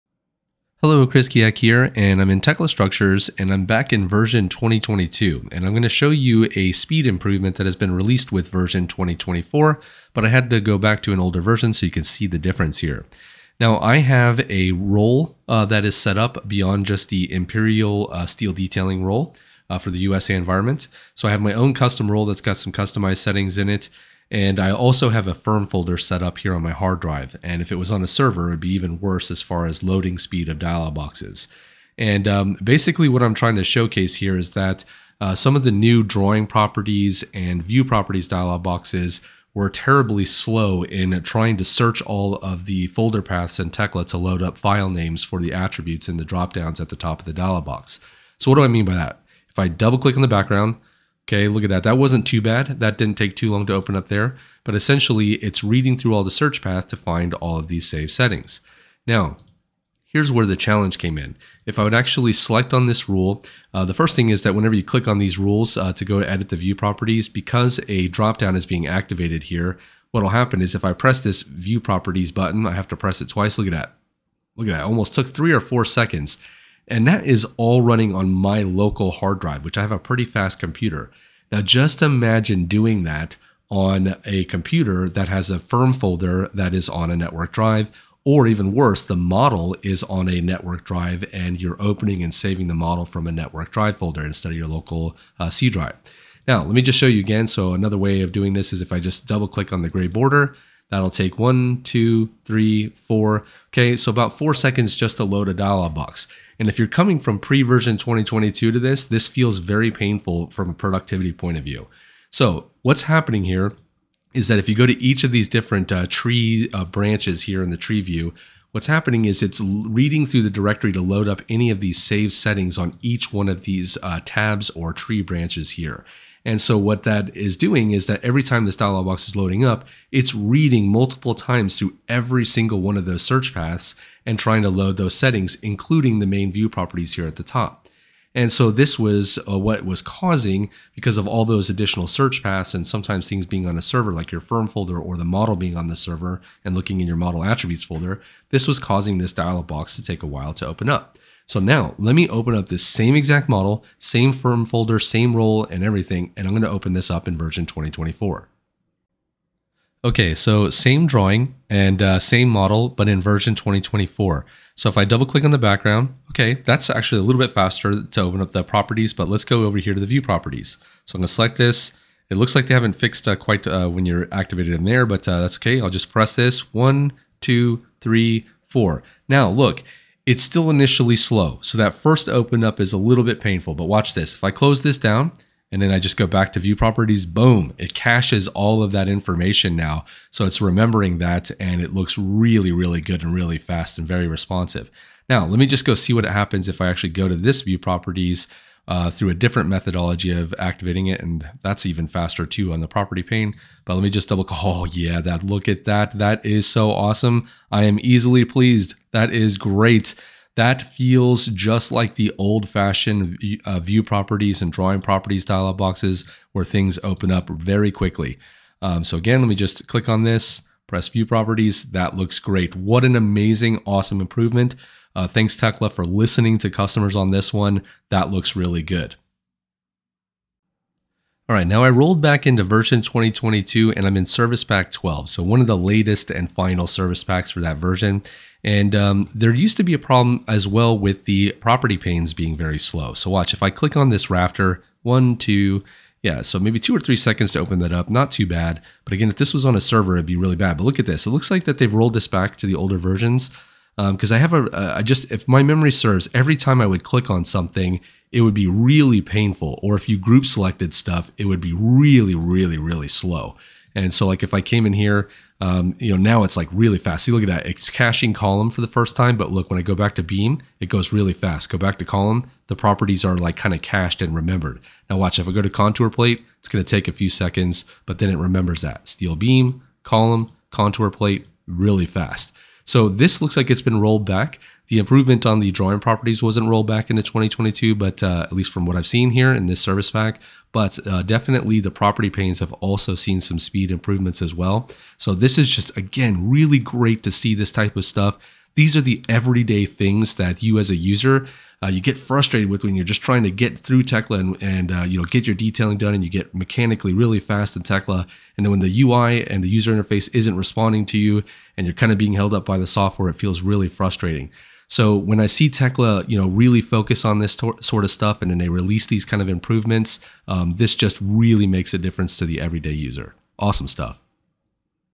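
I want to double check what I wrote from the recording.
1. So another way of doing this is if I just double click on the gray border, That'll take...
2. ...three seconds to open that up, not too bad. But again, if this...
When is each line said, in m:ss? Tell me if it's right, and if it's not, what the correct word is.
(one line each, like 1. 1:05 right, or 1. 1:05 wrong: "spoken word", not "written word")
1. 1:37 right
2. 4:07 right.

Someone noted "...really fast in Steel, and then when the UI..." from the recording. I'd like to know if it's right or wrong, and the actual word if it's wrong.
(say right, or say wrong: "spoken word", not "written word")
wrong: "Tekla", not "Steel".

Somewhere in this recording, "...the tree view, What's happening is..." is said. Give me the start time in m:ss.
1:57.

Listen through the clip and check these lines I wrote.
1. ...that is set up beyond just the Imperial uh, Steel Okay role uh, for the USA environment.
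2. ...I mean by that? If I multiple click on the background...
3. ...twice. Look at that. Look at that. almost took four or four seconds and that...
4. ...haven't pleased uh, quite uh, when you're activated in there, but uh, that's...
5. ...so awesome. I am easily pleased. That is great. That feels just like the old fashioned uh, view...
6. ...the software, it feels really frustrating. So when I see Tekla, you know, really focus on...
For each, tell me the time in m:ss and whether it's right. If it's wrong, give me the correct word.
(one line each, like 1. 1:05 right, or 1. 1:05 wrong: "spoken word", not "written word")
1. 0:15 wrong: "Detailing", not "Okay"
2. 0:48 wrong: "double", not "multiple"
3. 1:13 wrong: "three", not "four"
4. 2:52 wrong: "fixed", not "pleased"
5. 3:26 right
6. 5:12 right.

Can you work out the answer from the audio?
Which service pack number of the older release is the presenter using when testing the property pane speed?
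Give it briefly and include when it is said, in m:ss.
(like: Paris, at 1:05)
12, at 3:54.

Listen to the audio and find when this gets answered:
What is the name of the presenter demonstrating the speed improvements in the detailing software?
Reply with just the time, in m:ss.
0:01.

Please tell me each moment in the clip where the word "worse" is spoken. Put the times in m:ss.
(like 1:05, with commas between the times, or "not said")
0:29, 1:28.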